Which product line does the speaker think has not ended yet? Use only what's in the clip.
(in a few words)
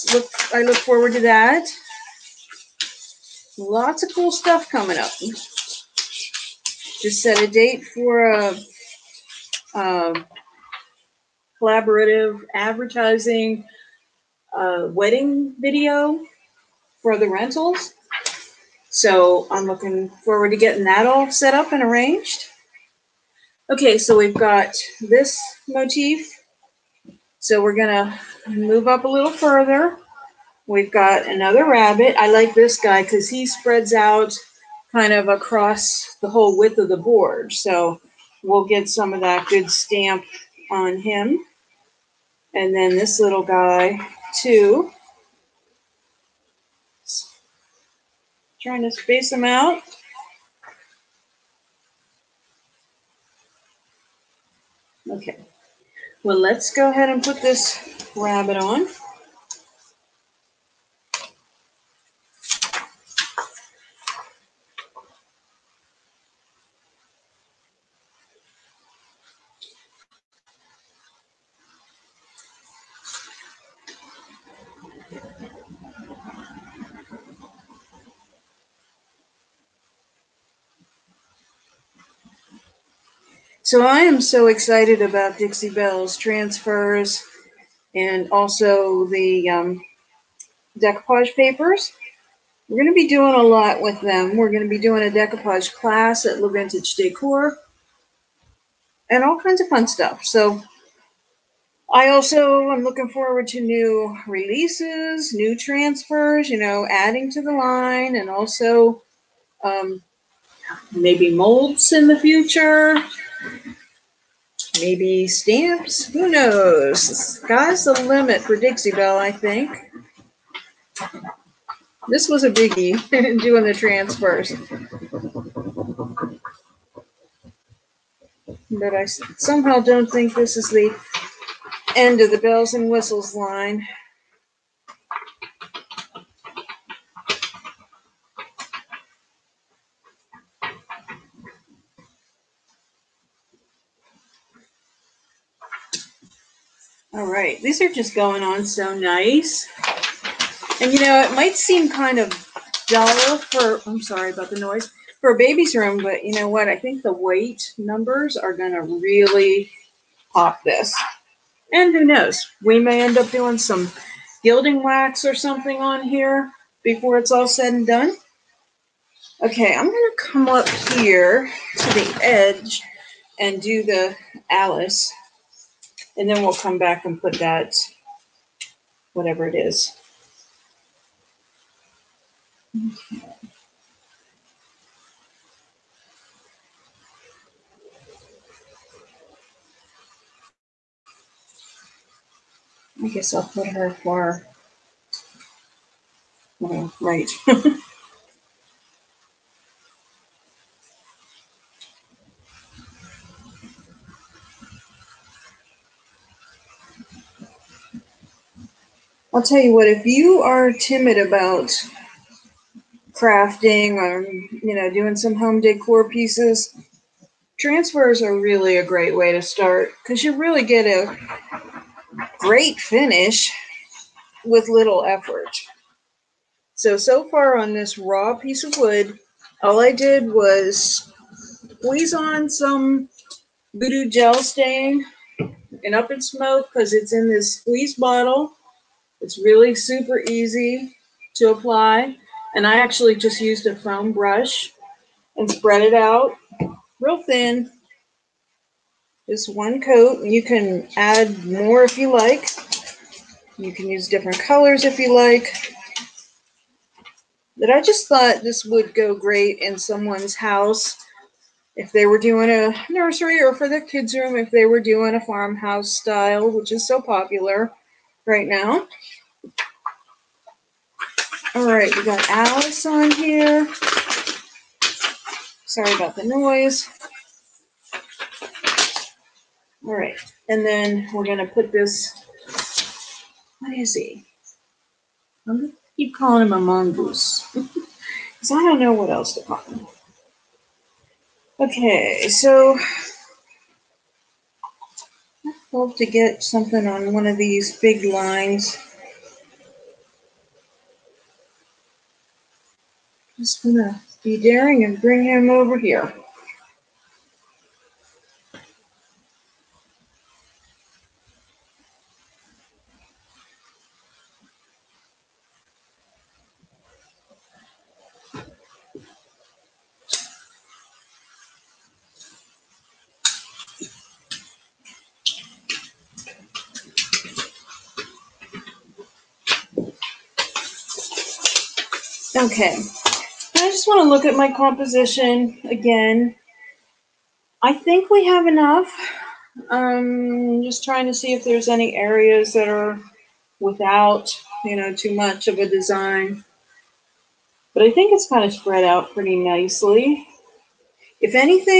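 Belles and whistles.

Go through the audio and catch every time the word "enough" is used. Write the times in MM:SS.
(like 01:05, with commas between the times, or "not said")
05:38.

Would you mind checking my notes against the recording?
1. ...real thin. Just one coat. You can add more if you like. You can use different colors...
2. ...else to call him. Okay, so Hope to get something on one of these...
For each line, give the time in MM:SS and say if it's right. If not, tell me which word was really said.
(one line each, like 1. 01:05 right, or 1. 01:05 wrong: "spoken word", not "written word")
1. 04:07 right
2. 04:49 right.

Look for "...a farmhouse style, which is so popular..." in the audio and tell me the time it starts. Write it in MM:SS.
04:25.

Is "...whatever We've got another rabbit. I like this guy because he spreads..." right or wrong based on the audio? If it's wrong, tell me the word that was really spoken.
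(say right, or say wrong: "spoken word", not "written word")
wrong: "further", not "whatever".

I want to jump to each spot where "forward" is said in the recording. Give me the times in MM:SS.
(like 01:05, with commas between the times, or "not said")
00:00, 00:20, 01:43.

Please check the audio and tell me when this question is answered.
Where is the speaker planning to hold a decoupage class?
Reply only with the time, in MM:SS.
01:36.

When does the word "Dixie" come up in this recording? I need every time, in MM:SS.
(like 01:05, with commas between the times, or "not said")
01:25, 01:58.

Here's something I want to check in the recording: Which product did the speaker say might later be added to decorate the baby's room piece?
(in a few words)
Gilding wax.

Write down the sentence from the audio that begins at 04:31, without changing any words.
All right, we got Alice on here.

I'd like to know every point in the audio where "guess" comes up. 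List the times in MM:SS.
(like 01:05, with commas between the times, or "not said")
03:13.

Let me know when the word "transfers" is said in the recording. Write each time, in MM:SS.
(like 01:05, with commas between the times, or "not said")
01:26, 01:45, 02:03, 03:37.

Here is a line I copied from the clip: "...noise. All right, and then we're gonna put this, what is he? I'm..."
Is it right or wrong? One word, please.
right.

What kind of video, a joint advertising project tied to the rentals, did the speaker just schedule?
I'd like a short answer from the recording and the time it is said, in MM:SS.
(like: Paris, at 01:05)
Wedding video, at 00:14.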